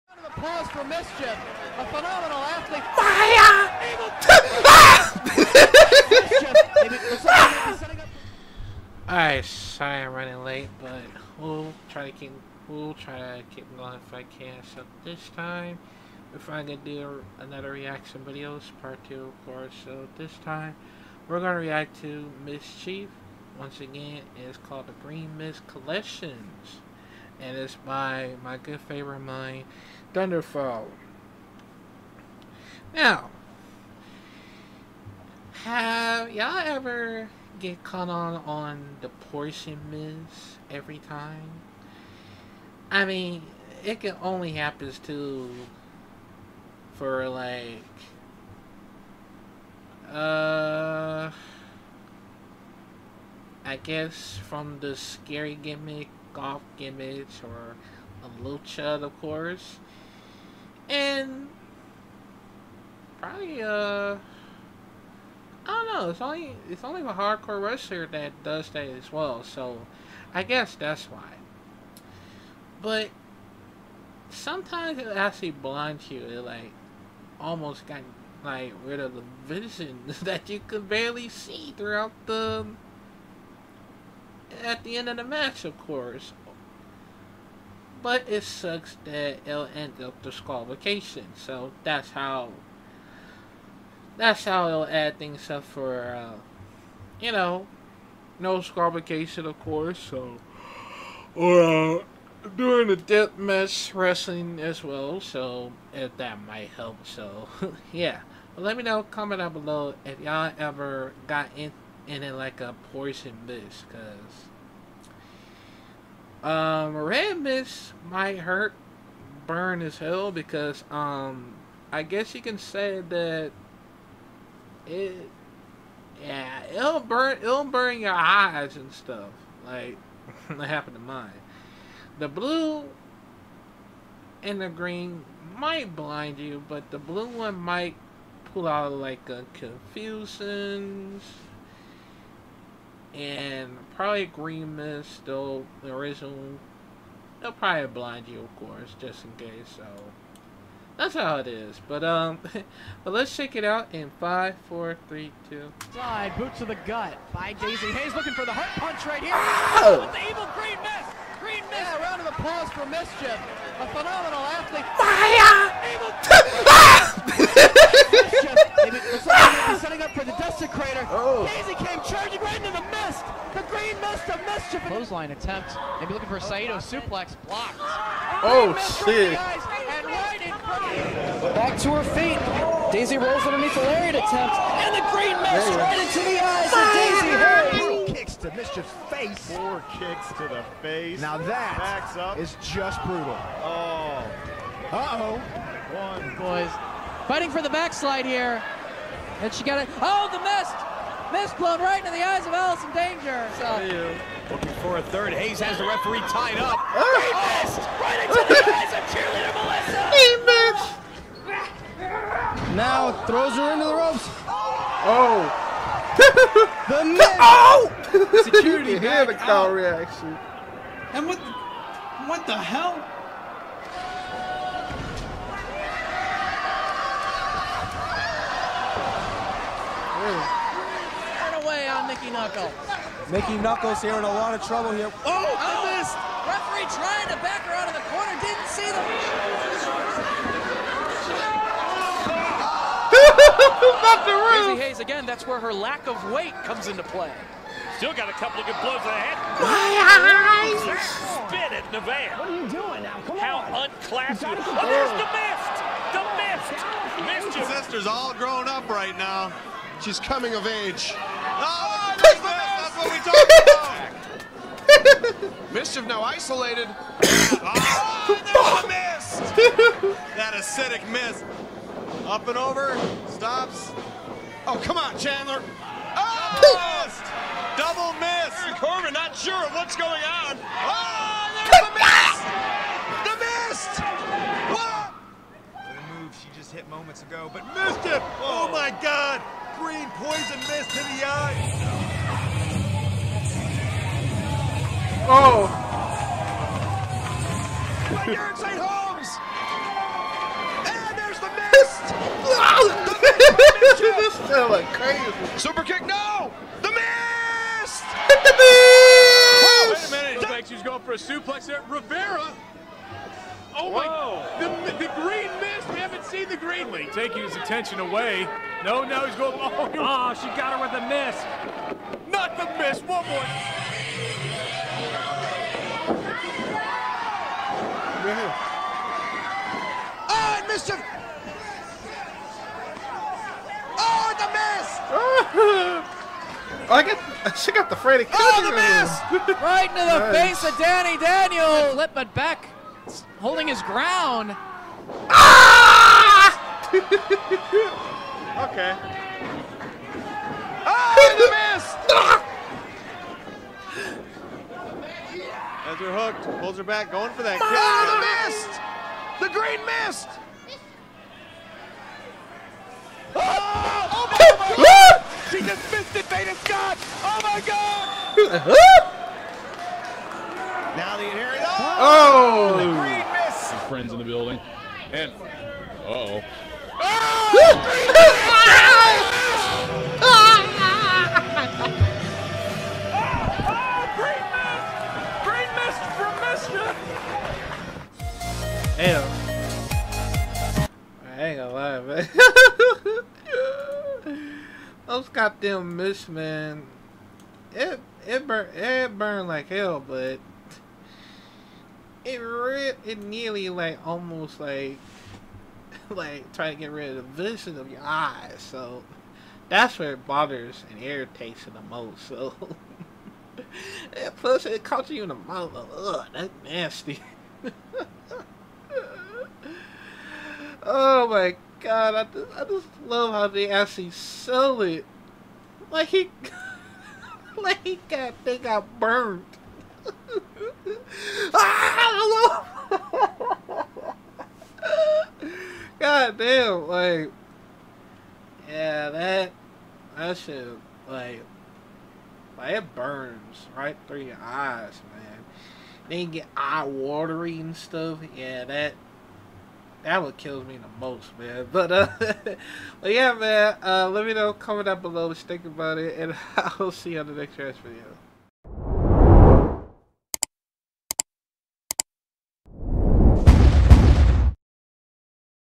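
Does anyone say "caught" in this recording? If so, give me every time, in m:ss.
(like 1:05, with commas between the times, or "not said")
0:37, 6:54.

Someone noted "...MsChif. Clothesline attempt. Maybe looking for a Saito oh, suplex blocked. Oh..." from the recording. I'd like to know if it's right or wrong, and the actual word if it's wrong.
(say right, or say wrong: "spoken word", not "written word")
right.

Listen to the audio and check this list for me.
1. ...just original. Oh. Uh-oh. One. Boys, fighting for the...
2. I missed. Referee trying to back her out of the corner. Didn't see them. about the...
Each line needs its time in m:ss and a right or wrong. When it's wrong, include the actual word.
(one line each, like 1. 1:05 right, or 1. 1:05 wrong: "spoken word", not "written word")
1. 3:12 wrong: "brutal", not "original"
2. 3:55 right.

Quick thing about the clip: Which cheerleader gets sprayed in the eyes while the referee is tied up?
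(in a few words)
Melissa.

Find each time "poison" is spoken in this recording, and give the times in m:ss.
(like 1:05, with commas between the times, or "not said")
1:52, 4:50.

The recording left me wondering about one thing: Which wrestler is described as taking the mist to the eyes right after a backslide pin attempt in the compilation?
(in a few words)
Allison Danger.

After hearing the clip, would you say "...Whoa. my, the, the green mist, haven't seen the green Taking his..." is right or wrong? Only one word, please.
right.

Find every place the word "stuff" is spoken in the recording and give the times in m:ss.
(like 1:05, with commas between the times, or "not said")
2:08, 7:27.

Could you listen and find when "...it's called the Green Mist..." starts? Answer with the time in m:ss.
0:24.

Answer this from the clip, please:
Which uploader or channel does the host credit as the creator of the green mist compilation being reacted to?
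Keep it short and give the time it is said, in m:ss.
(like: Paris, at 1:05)
ThunderFilez, at 0:30.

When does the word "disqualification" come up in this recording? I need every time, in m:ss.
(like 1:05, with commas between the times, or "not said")
1:30, 1:38.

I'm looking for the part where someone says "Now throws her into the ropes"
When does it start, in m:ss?
3:32.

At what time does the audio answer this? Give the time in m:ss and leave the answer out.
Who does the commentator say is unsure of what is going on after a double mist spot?
4:38.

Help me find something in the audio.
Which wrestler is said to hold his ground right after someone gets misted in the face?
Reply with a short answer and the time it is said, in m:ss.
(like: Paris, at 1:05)
Beck, at 5:42.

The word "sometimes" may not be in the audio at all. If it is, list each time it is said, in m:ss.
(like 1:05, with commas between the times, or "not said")
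1:14.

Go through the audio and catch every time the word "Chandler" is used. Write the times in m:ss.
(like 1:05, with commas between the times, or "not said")
4:35.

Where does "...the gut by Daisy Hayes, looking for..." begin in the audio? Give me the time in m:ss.
2:36.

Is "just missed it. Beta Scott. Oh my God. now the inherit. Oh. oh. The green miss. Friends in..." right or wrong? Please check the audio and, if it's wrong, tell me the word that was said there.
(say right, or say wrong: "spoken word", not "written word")
right.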